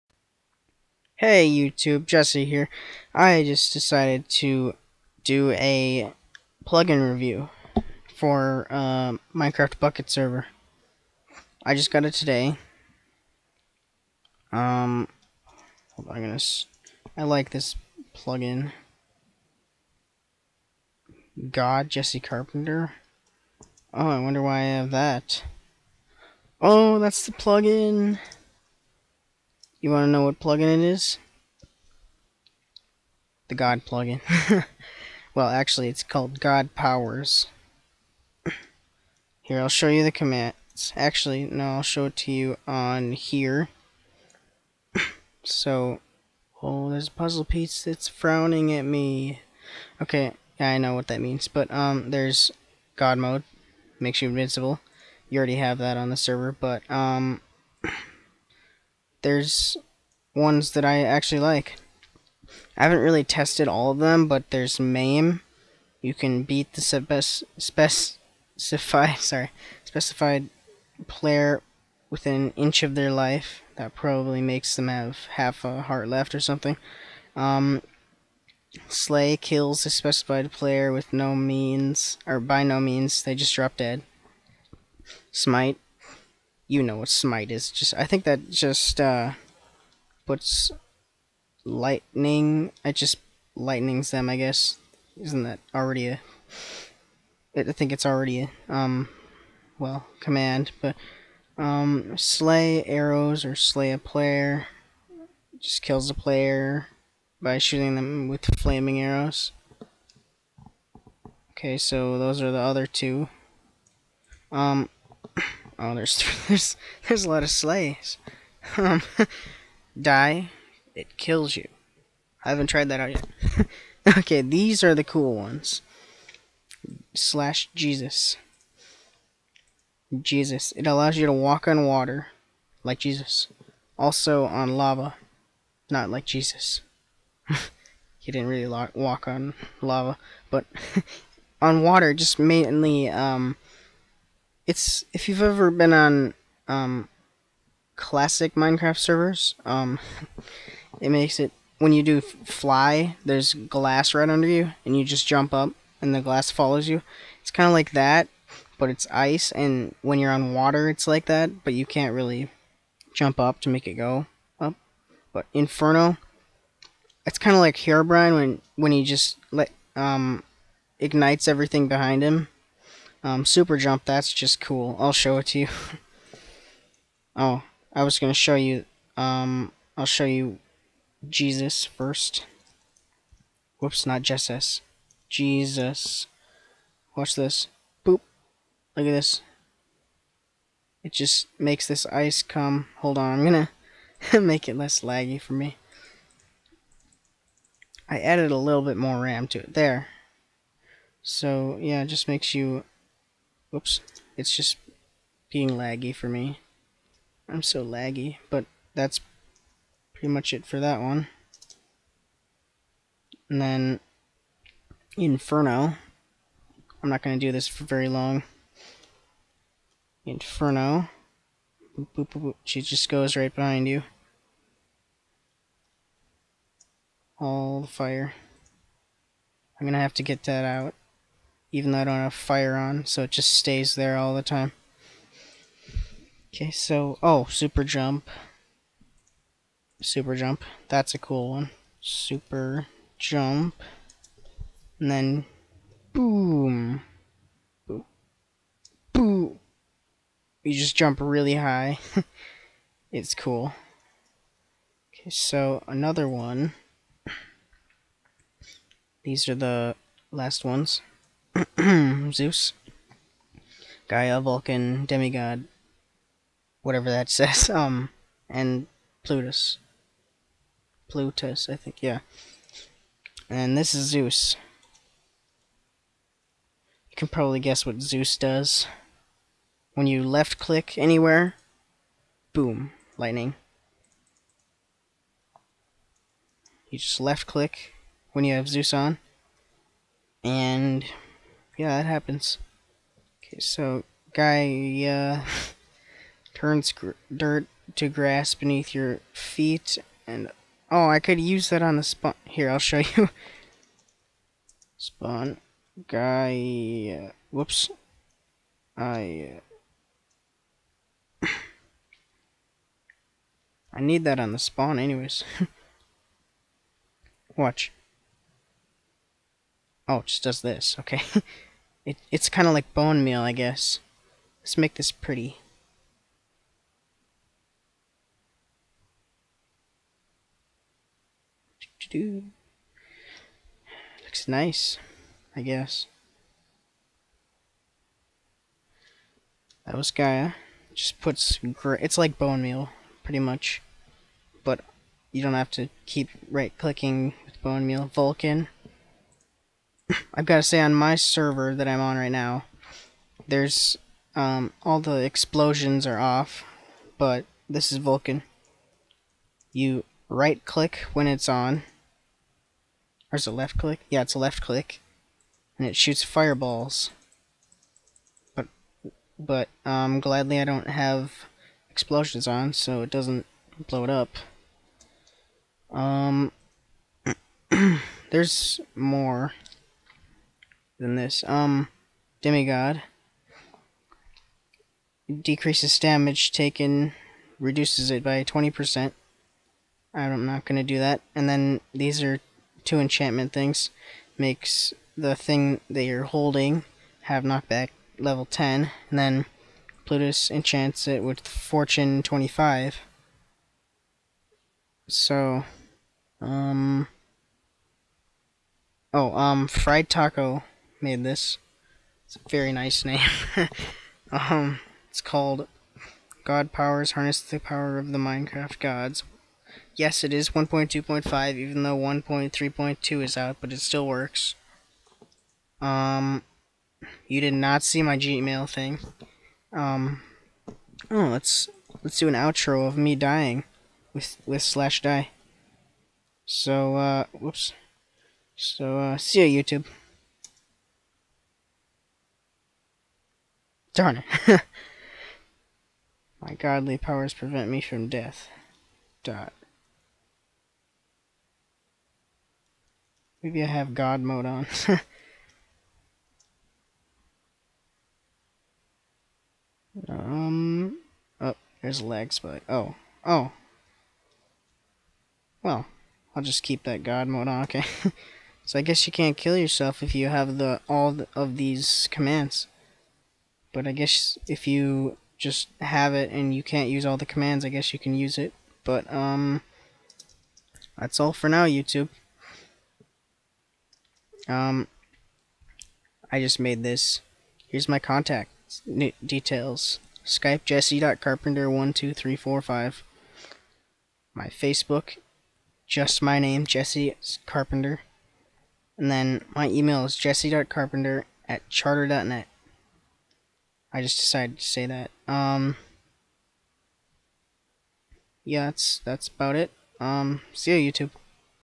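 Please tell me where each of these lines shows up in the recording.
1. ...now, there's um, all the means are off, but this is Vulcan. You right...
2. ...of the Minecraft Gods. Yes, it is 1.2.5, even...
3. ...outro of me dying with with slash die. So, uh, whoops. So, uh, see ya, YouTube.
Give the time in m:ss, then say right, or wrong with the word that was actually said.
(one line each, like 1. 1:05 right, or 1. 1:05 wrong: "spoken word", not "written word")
1. 5:52 wrong: "explosions", not "means"
2. 6:57 right
3. 7:12 right.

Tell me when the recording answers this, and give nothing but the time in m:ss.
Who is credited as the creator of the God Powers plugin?
6:49.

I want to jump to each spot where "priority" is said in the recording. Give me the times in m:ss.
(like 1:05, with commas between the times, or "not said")
not said.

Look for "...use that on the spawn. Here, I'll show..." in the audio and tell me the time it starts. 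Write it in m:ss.
5:01.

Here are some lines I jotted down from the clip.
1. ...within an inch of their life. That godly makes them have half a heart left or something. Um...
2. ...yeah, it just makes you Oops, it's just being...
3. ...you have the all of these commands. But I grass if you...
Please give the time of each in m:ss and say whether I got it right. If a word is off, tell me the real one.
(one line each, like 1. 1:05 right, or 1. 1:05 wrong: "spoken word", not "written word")
1. 1:12 wrong: "probably", not "godly"
2. 3:21 right
3. 7:50 wrong: "guess", not "grass".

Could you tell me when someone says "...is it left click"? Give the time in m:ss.
6:03.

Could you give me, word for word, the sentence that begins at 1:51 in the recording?
Okay, so those are the other two.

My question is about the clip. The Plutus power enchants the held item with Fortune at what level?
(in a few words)
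25.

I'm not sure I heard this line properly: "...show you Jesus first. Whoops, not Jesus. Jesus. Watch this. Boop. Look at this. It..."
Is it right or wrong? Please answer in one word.
right.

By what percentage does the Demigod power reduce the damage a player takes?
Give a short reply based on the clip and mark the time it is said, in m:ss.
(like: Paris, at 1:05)
20%, at 6:28.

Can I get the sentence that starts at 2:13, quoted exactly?
Also on lava, not like Jesus.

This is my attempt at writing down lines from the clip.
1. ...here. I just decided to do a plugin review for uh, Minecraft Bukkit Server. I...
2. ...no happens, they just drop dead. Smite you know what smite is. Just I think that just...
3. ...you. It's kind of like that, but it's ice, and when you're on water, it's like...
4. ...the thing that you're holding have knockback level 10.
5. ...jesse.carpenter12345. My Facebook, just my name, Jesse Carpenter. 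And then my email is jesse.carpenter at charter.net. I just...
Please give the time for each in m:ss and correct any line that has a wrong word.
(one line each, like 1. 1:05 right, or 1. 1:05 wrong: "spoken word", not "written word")
1. 0:02 right
2. 1:22 wrong: "means", not "happens"
3. 2:36 right
4. 6:35 right
5. 8:10 right.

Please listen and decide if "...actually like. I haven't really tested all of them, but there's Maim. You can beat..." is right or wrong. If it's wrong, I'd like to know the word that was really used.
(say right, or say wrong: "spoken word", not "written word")
right.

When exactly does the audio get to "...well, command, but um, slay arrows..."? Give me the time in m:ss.
1:39.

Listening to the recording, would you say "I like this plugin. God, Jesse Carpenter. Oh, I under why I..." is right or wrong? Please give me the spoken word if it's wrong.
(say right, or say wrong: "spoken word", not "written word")
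wrong: "wonder", not "under".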